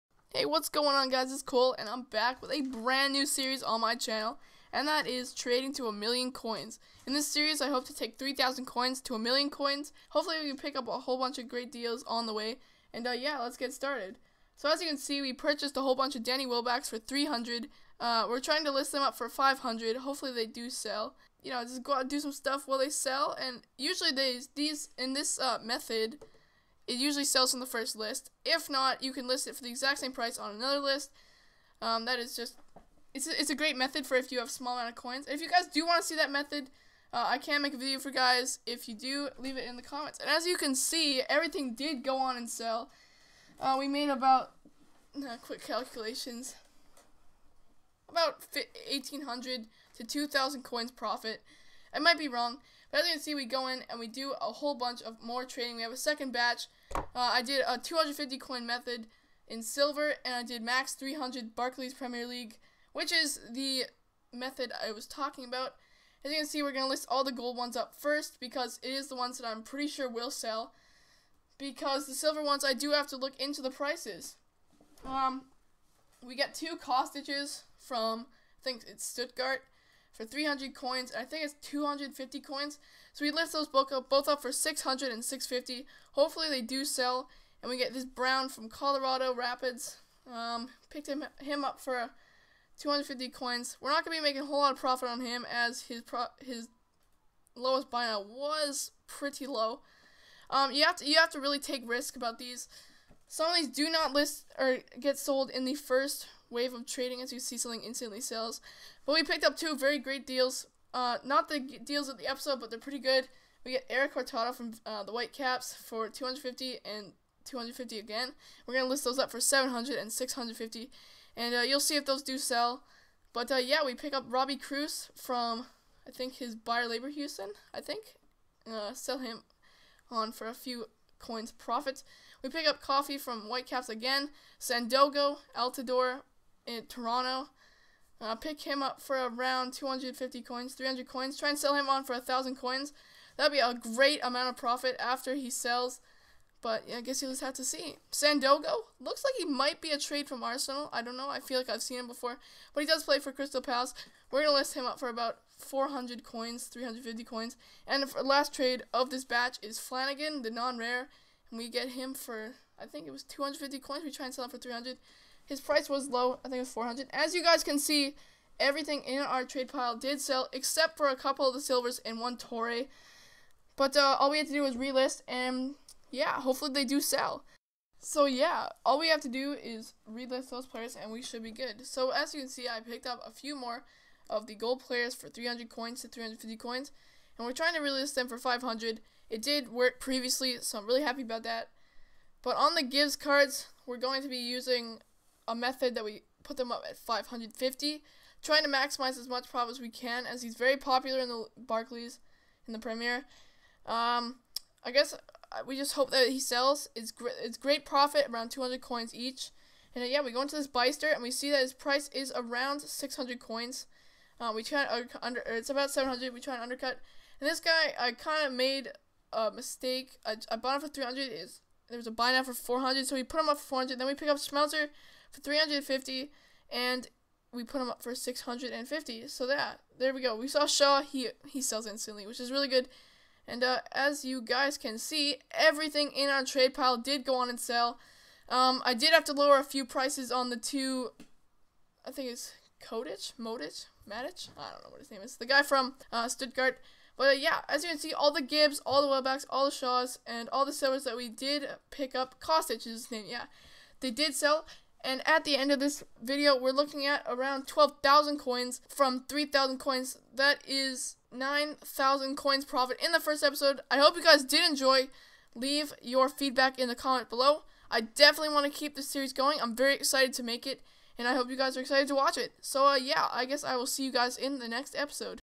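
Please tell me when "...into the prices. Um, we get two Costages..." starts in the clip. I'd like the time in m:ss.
1:13.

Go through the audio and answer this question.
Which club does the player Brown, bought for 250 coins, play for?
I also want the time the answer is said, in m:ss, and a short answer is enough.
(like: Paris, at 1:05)
Colorado Rapids, at 1:28.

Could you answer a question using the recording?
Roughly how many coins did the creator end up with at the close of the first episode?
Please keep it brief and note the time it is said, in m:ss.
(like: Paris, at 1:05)
12,000, at 4:17.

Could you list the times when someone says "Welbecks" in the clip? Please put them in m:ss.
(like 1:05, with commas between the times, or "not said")
0:16, 4:09.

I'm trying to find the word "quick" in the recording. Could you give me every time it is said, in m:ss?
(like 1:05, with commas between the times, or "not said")
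0:45.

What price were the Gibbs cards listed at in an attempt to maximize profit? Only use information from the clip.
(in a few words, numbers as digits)
550.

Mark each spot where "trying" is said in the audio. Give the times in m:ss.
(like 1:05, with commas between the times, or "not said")
0:18, 3:07, 3:18.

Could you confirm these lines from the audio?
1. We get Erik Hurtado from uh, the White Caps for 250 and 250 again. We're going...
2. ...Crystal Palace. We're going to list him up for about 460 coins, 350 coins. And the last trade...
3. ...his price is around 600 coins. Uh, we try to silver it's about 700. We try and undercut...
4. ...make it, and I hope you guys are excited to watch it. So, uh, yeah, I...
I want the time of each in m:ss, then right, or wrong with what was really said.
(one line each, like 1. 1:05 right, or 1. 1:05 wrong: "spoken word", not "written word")
1. 1:53 right
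2. 2:33 wrong: "400", not "460"
3. 3:31 wrong: "under", not "silver"
4. 4:30 right.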